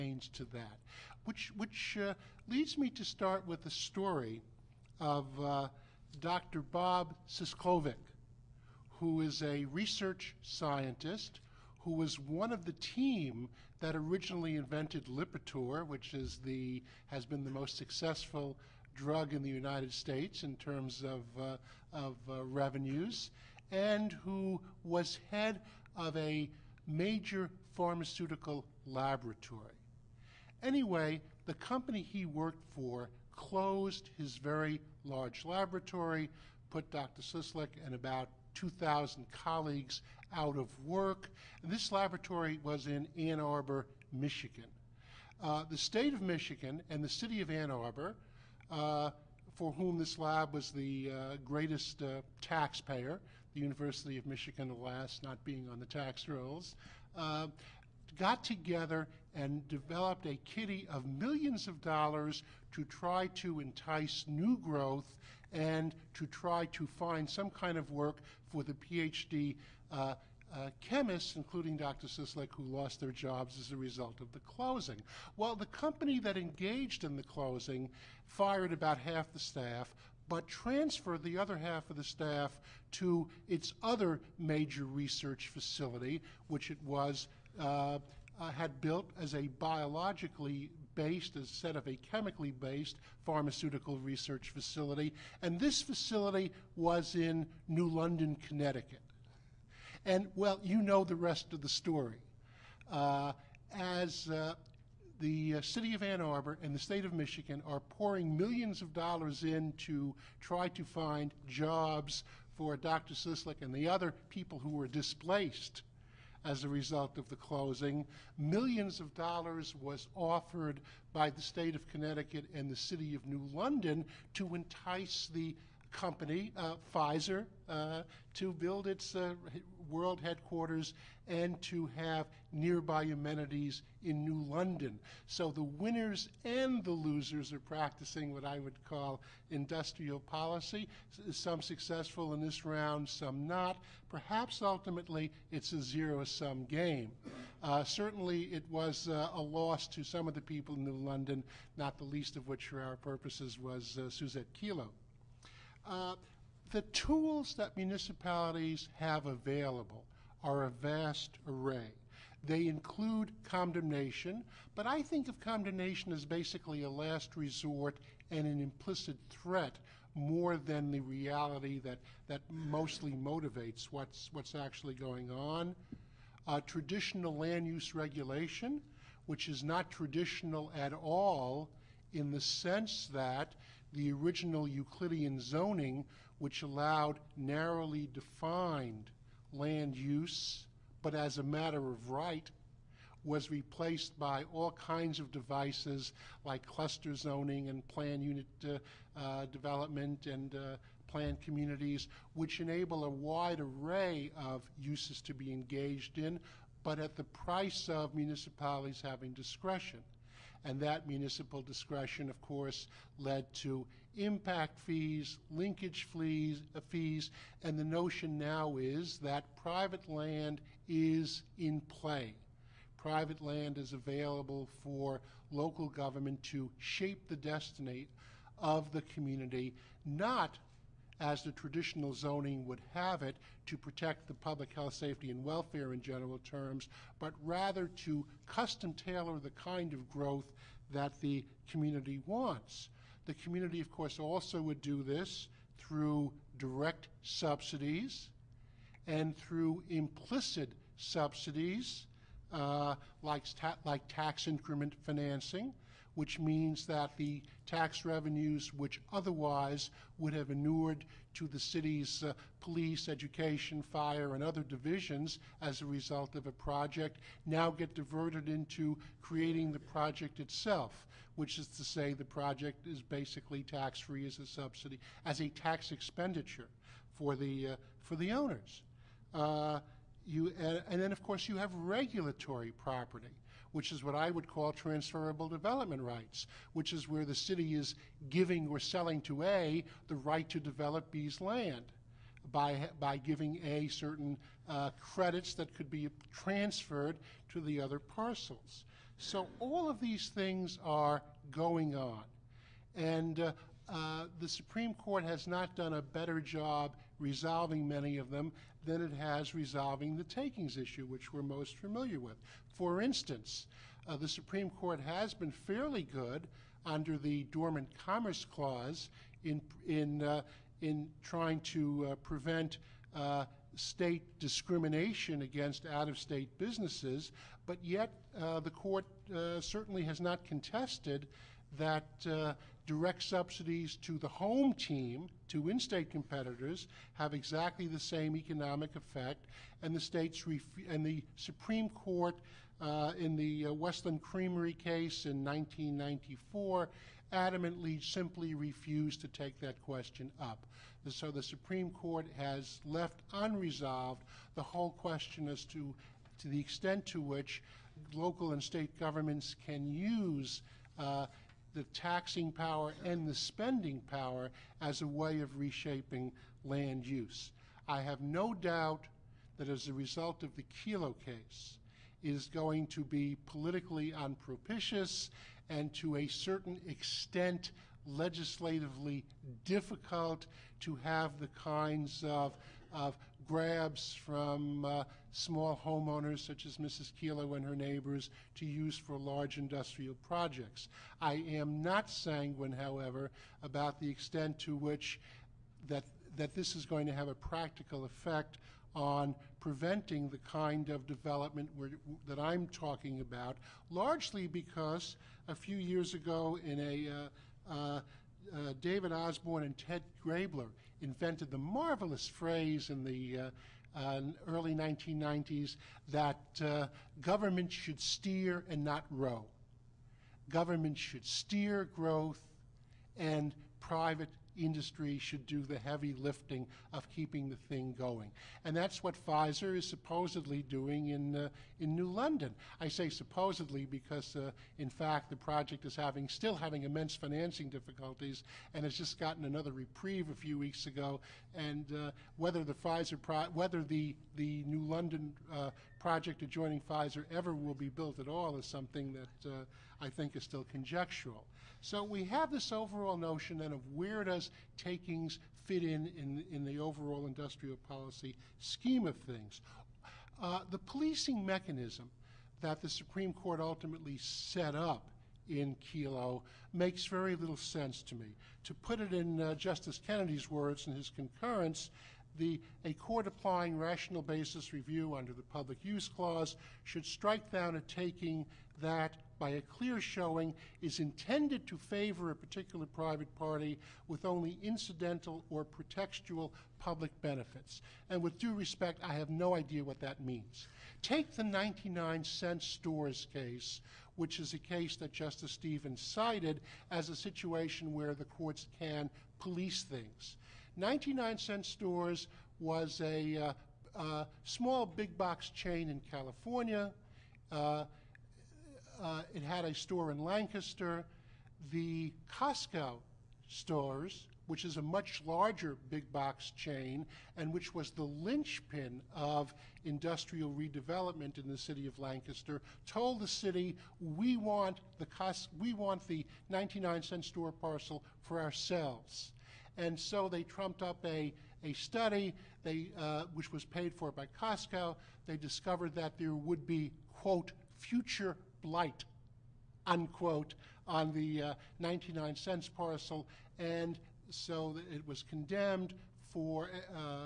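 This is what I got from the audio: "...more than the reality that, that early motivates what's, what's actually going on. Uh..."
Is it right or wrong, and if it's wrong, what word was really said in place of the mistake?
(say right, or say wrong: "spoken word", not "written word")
wrong: "mostly", not "early".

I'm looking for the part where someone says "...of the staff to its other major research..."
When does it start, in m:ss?
1:21.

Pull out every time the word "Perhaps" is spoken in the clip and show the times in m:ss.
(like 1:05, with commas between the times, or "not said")
2:24.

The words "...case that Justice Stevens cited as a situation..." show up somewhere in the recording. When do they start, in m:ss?
8:14.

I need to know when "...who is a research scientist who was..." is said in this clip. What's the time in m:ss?
0:08.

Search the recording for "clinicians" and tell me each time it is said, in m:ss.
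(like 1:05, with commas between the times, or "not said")
not said.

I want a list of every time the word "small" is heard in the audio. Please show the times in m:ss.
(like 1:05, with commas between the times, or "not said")
6:25, 8:24.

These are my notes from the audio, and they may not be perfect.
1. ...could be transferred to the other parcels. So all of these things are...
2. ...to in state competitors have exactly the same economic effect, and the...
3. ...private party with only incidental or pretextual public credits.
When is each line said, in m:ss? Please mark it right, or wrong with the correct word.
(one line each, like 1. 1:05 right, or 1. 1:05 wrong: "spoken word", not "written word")
1. 4:55 right
2. 5:35 right
3. 8:02 wrong: "benefits", not "credits".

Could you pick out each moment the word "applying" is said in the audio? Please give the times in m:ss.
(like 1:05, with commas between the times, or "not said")
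7:53.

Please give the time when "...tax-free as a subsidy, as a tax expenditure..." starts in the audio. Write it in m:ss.
4:33.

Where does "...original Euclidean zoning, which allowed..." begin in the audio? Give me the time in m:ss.
3:04.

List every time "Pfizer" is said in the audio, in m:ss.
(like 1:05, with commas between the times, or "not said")
2:06, 7:09, 7:22, 7:26.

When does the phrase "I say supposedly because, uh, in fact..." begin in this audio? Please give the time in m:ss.
7:12.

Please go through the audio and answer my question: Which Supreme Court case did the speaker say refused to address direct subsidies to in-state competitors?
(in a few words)
West Lynn Creamery.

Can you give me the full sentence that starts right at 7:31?
So we have this overall notion then of where does takings fit in in, in the overall industrial policy scheme of things.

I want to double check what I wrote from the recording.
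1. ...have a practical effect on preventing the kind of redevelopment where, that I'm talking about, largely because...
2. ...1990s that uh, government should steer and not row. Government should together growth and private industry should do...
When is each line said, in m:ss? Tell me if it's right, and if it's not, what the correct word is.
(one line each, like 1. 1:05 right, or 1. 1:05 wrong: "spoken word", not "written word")
1. 6:37 wrong: "development", not "redevelopment"
2. 6:54 wrong: "steer", not "together".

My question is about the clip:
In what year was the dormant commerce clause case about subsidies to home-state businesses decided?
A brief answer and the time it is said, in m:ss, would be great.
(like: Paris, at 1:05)
1994, at 5:45.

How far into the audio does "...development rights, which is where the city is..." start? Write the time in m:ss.
4:45.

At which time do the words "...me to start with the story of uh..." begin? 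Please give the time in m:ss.
0:02.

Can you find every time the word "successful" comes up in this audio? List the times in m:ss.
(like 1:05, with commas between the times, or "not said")
0:17, 2:21.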